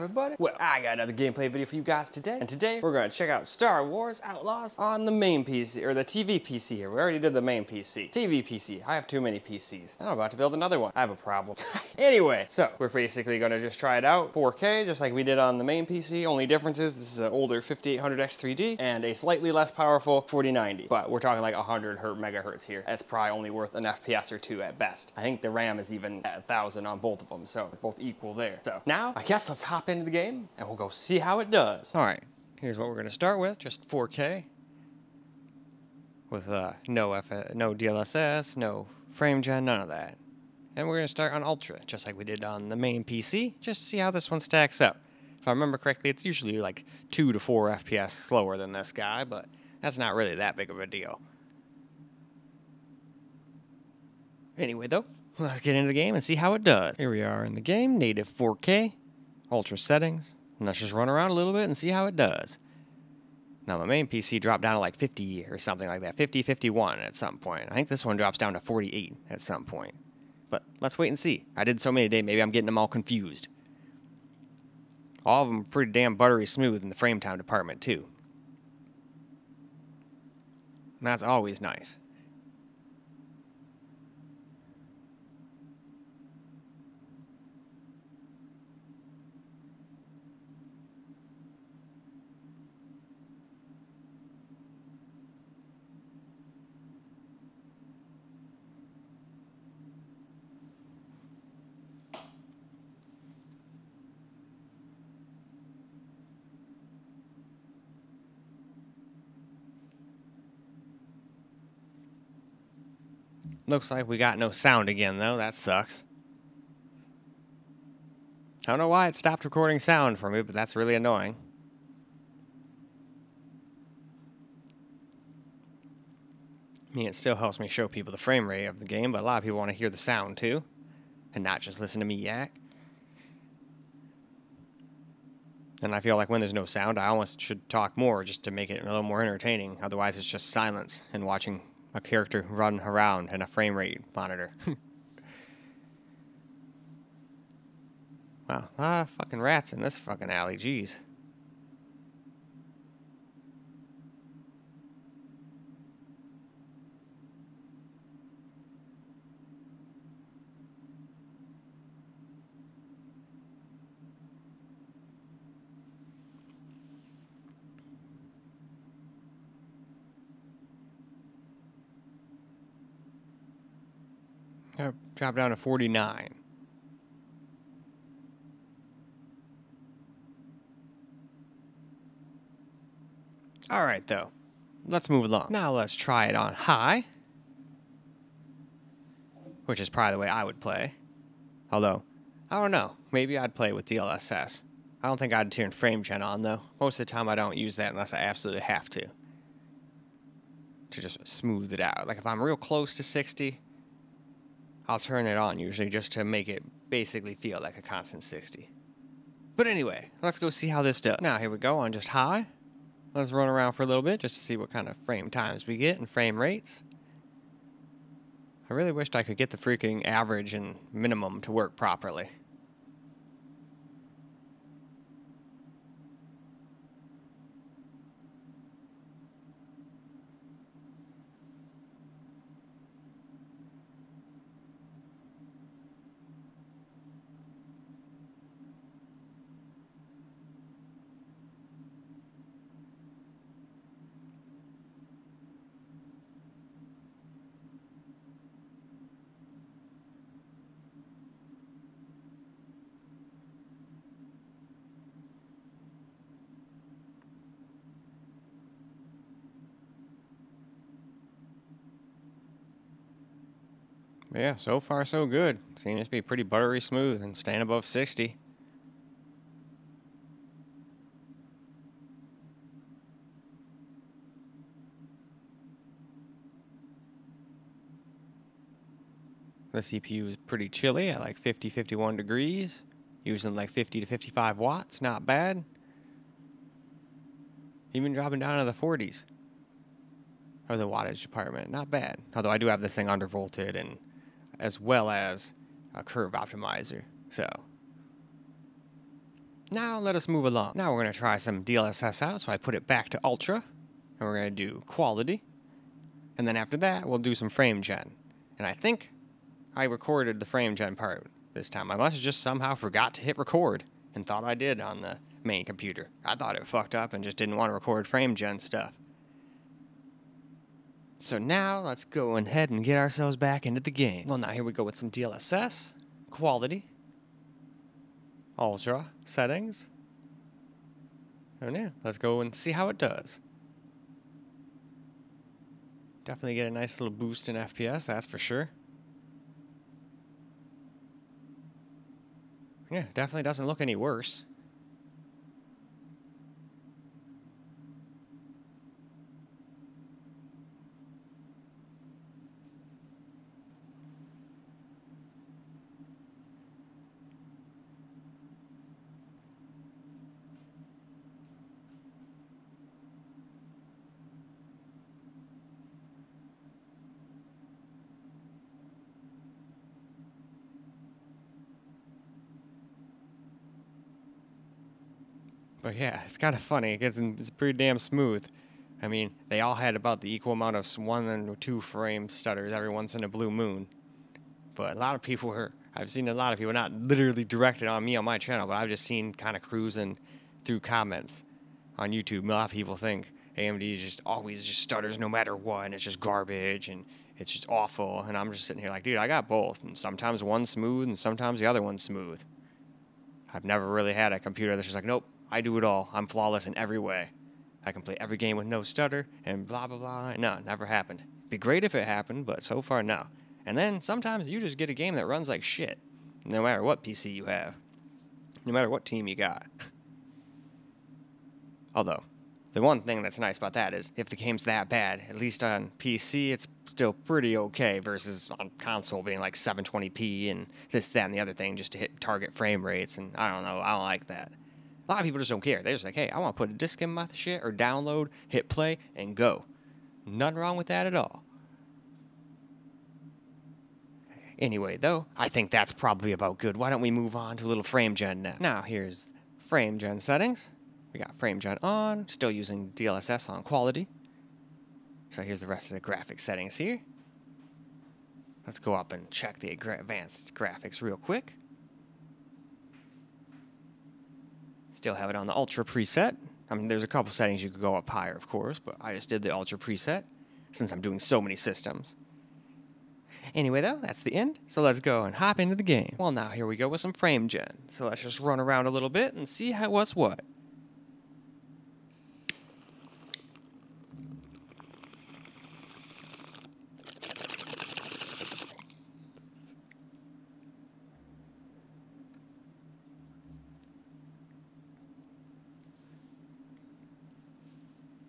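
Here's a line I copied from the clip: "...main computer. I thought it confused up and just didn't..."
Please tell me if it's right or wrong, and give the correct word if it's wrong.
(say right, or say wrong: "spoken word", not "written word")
wrong: "fucked", not "confused".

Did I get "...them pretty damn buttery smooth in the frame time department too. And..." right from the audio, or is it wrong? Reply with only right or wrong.
right.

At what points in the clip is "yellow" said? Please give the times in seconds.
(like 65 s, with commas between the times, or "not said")
not said.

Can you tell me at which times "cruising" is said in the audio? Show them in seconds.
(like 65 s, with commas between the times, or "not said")
389 s.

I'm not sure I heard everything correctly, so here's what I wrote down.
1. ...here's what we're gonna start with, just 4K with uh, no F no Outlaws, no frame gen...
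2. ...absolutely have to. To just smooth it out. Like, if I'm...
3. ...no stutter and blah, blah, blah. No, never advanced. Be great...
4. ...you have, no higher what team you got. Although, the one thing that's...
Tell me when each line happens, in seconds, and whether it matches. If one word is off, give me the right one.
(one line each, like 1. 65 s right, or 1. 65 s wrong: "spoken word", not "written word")
1. 32 s wrong: "DLSS", not "Outlaws"
2. 198 s right
3. 408 s wrong: "happened", not "advanced"
4. 417 s wrong: "matter", not "higher".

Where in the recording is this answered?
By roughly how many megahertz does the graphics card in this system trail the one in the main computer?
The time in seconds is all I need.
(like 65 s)
21 s.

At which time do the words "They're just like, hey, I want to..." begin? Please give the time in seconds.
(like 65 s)
435 s.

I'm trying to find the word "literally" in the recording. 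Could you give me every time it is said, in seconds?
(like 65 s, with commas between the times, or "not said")
386 s.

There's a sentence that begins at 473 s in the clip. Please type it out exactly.
Anyway, though, that's the end, so let's go and hop into the game.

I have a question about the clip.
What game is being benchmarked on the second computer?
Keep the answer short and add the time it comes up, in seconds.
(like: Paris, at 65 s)
Star Wars Outlaws, at 3 s.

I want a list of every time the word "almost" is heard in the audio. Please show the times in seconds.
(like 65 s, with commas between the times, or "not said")
137 s.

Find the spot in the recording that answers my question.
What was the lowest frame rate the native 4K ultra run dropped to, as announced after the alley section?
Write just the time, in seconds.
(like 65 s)
175 s.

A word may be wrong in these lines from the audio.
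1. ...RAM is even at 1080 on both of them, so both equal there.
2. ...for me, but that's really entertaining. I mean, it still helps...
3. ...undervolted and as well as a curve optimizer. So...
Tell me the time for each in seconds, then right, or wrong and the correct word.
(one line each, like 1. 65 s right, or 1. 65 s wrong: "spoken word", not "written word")
1. 25 s wrong: "1000", not "1080"
2. 120 s wrong: "annoying", not "entertaining"
3. 293 s right.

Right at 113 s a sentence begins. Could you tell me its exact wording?
Looks like we got no sound again, though.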